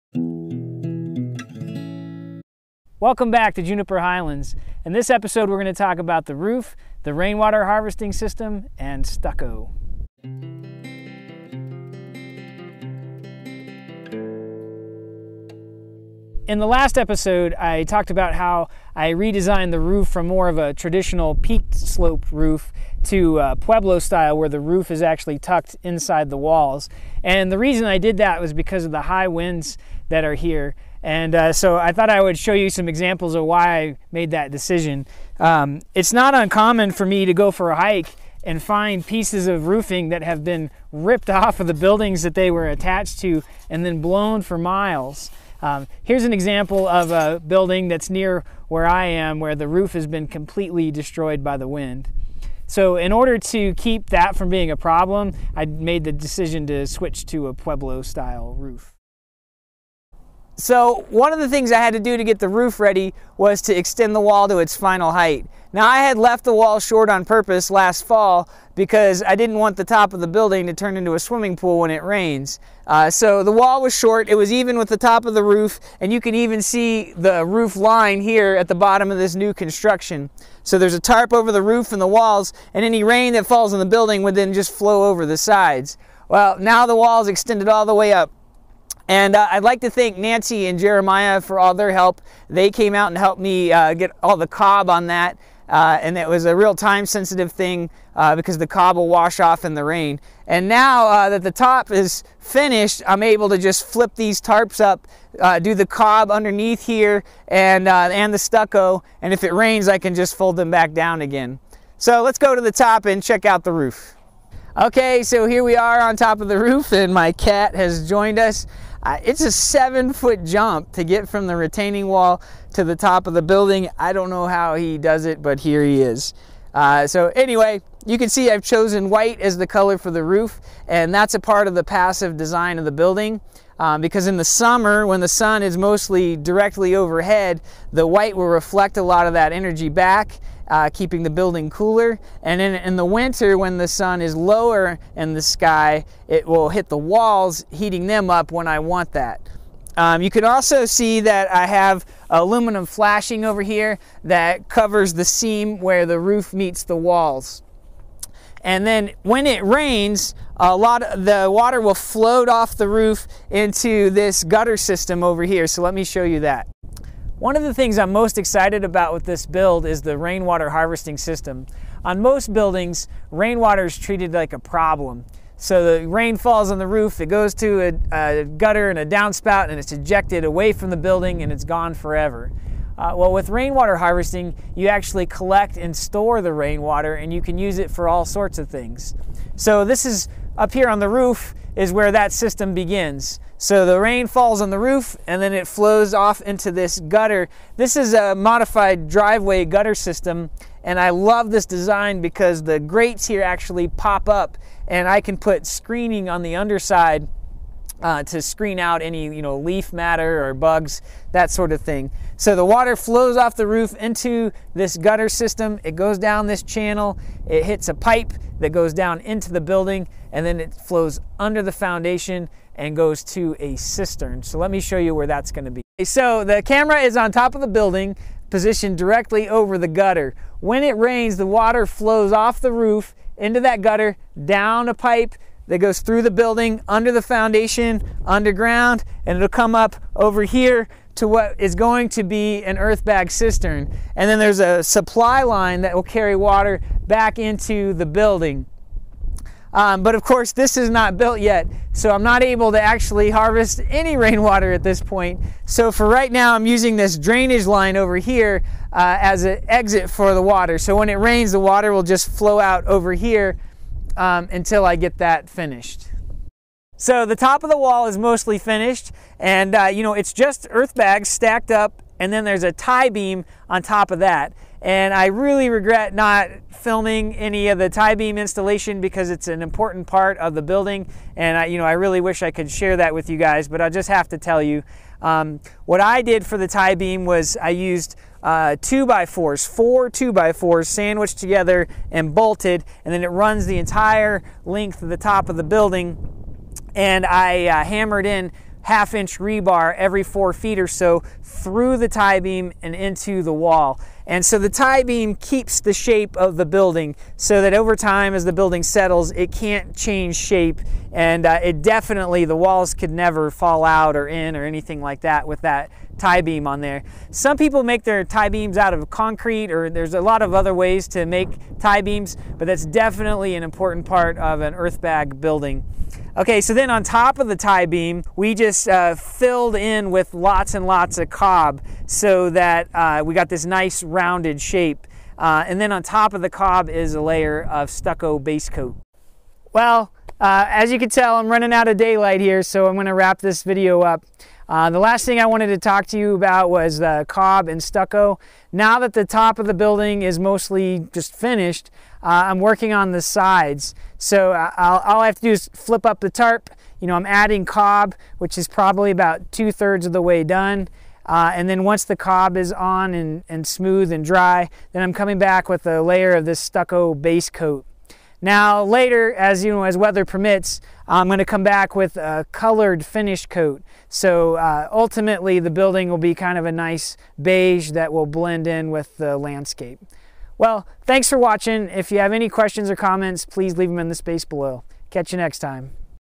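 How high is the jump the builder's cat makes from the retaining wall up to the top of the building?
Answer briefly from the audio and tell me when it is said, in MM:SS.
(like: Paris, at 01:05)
7 feet, at 01:59.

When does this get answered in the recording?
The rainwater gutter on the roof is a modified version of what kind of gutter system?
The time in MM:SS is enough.
03:19.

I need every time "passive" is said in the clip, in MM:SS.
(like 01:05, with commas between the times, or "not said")
02:11.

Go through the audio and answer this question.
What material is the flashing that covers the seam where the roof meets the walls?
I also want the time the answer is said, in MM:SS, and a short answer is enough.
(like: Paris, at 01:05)
Aluminum, at 02:32.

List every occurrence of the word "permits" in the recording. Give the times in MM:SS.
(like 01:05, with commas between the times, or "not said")
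06:10.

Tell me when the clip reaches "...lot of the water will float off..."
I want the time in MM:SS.
02:40.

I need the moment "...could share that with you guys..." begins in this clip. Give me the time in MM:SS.
04:42.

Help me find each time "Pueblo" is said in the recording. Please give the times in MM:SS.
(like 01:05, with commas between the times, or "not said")
00:23, 00:57.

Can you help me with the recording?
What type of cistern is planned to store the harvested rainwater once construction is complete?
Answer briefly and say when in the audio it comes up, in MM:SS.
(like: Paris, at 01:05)
Earth bag cistern, at 04:02.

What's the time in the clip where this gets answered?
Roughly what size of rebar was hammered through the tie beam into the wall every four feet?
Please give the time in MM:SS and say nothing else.
04:58.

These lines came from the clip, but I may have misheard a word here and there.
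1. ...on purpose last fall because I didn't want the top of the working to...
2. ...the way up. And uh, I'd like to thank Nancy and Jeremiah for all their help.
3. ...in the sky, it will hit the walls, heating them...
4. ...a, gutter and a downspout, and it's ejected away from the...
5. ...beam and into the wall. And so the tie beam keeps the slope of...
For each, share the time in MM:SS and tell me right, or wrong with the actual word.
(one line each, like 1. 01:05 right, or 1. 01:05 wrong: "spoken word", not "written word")
1. 01:07 wrong: "building", not "working"
2. 01:27 right
3. 02:25 right
4. 02:58 right
5. 05:02 wrong: "shape", not "slope".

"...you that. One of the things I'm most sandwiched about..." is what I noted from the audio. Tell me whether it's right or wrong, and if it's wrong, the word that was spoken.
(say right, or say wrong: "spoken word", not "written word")
wrong: "excited", not "sandwiched".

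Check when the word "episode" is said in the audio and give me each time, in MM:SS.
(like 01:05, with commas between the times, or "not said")
00:05, 00:16.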